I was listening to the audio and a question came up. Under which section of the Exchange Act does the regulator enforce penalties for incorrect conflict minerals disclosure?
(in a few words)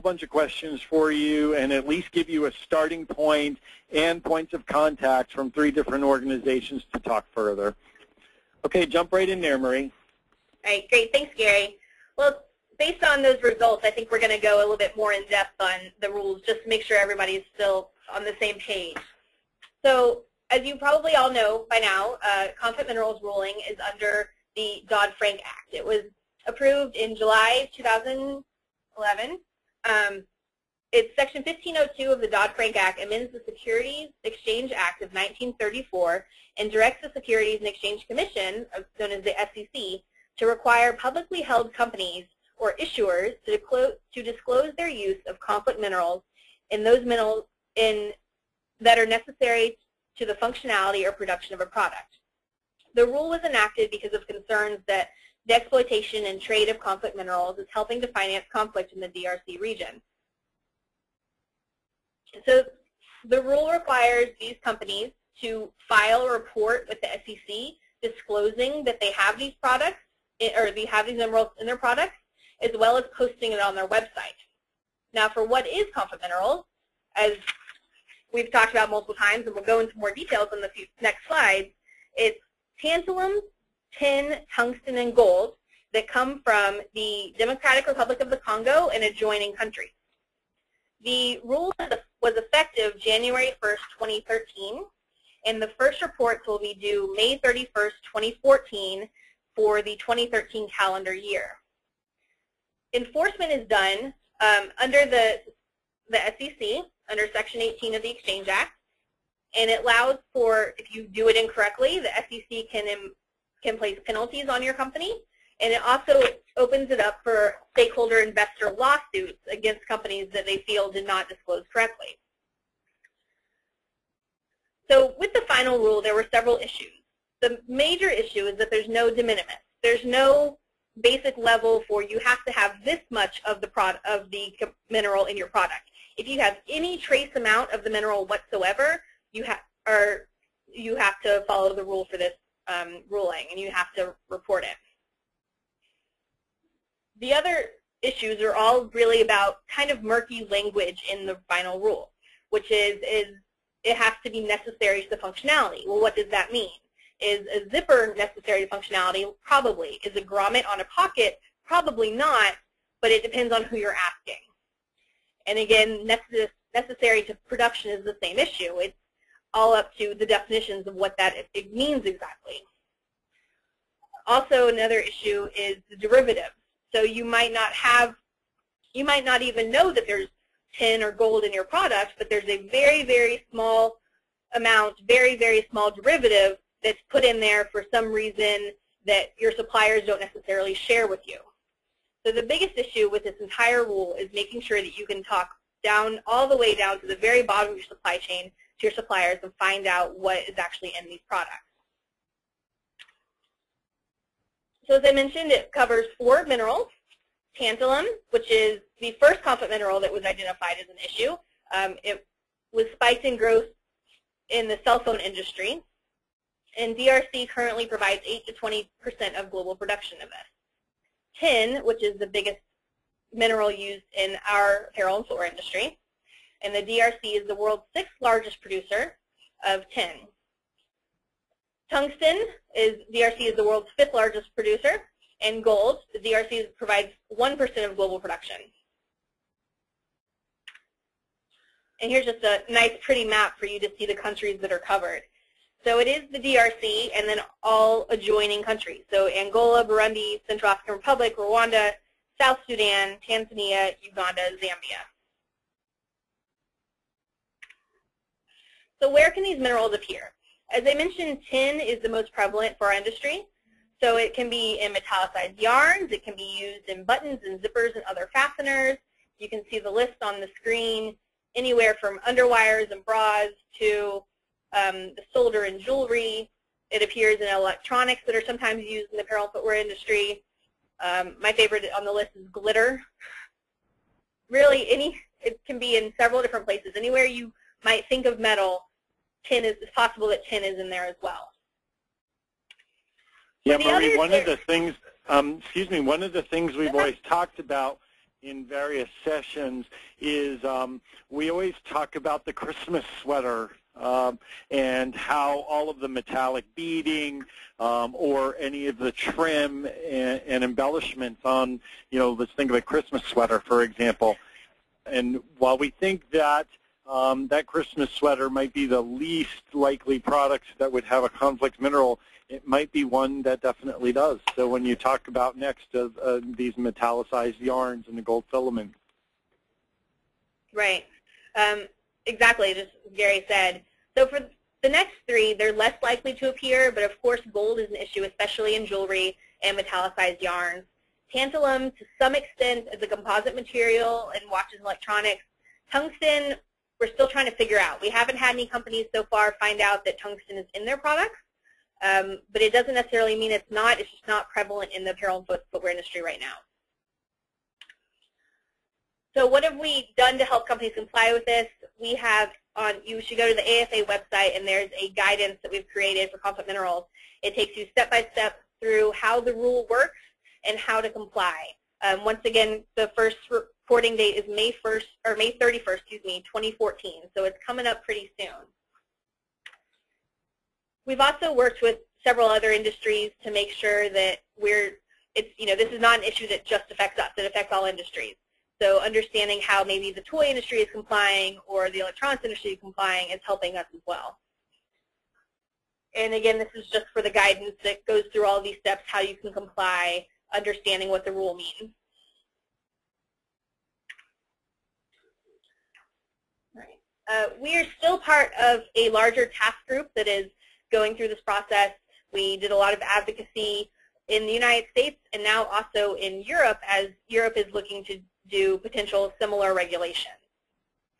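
Section 18.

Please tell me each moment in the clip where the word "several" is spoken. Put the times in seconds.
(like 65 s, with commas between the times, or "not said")
126 s, 286 s, 382 s.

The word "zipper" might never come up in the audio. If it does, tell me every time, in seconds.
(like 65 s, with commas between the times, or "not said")
157 s, 267 s.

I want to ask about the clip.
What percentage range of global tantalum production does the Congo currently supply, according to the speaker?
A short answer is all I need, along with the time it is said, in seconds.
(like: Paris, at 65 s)
8 to 20 percent, at 218 s.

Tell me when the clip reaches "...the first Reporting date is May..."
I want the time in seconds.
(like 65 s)
372 s.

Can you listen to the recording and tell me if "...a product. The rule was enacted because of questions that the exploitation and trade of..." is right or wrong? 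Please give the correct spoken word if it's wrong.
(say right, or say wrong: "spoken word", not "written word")
wrong: "concerns", not "questions".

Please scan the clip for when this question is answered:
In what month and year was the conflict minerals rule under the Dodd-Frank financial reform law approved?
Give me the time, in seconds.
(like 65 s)
27 s.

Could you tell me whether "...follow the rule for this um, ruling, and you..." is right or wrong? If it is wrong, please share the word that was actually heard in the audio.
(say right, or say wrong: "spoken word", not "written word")
right.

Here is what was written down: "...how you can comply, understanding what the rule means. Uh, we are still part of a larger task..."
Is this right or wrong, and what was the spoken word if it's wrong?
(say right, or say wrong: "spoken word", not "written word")
right.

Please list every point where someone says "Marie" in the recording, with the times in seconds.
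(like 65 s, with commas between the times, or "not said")
9 s, 293 s.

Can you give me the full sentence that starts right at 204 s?
So as I mentioned, it covers four minerals, tantalum, which is the first conflict mineral that was identified as an issue.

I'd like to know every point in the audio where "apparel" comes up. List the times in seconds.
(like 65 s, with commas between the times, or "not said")
224 s, 279 s, 355 s.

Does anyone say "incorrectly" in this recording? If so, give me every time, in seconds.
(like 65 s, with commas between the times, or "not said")
111 s.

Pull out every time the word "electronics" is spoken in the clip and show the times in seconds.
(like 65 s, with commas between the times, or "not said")
277 s, 344 s, 391 s.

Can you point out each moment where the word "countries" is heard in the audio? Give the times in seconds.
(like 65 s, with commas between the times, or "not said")
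89 s, 244 s, 248 s.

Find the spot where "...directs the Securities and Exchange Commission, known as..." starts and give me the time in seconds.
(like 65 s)
36 s.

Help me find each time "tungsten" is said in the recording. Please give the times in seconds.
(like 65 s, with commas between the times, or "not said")
84 s, 231 s, 345 s, 350 s.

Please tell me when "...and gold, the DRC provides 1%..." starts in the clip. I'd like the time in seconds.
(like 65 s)
235 s.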